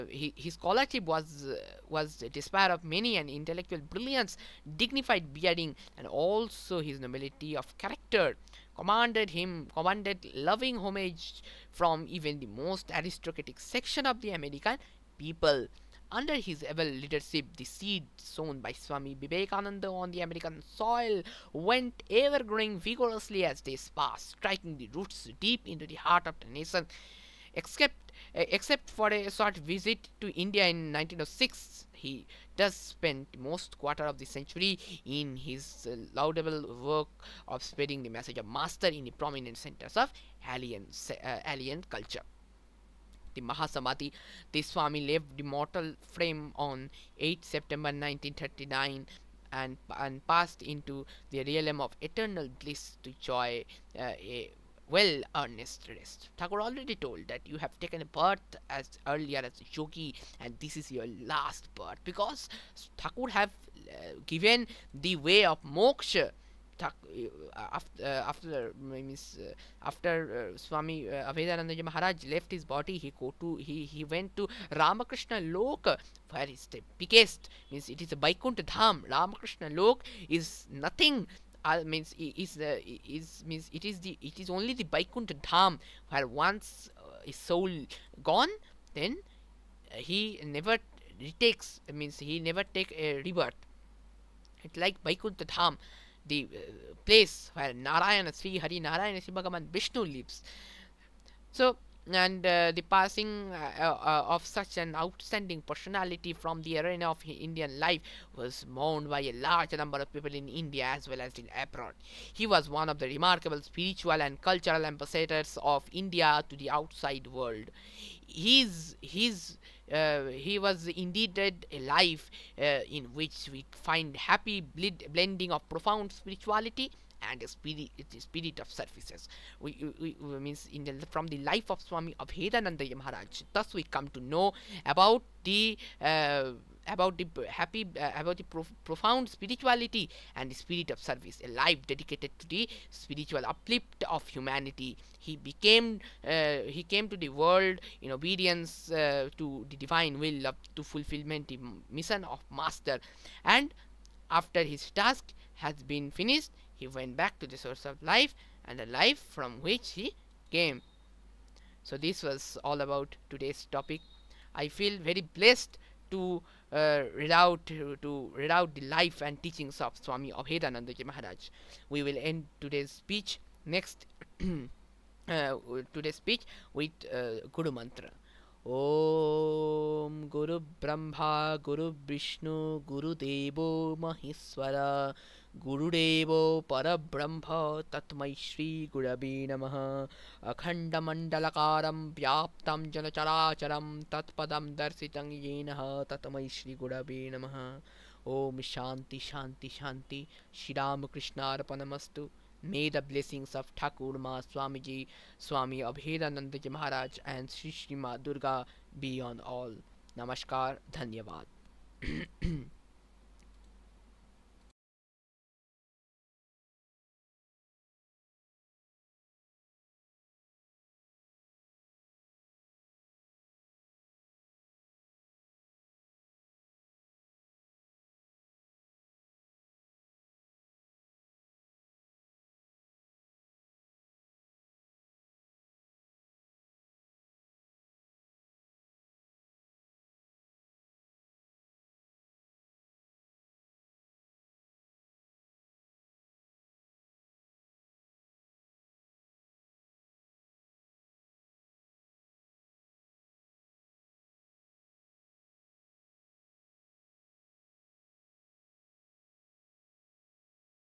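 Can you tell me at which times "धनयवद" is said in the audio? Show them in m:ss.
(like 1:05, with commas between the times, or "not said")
3:30.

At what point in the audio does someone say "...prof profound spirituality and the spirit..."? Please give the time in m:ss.
2:18.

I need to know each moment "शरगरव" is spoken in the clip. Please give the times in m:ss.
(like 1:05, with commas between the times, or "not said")
3:08, 3:16.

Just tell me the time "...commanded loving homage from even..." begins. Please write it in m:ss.
0:09.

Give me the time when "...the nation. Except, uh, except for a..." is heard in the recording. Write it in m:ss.
0:26.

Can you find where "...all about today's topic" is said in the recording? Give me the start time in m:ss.
2:42.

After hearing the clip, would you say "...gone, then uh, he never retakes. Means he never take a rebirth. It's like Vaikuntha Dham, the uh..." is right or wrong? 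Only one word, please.
right.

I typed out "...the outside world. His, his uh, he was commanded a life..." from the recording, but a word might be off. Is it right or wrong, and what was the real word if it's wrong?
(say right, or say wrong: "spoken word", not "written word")
wrong: "indeed", not "commanded".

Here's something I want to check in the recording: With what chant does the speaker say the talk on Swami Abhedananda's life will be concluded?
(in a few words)
Guru Mantra.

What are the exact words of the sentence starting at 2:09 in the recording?
We, we, we means in the, from the life of Swami of Abhedananda Maharaj.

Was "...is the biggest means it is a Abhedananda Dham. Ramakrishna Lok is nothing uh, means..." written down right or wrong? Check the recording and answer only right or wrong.
wrong.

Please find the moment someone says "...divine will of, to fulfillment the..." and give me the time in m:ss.
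2:29.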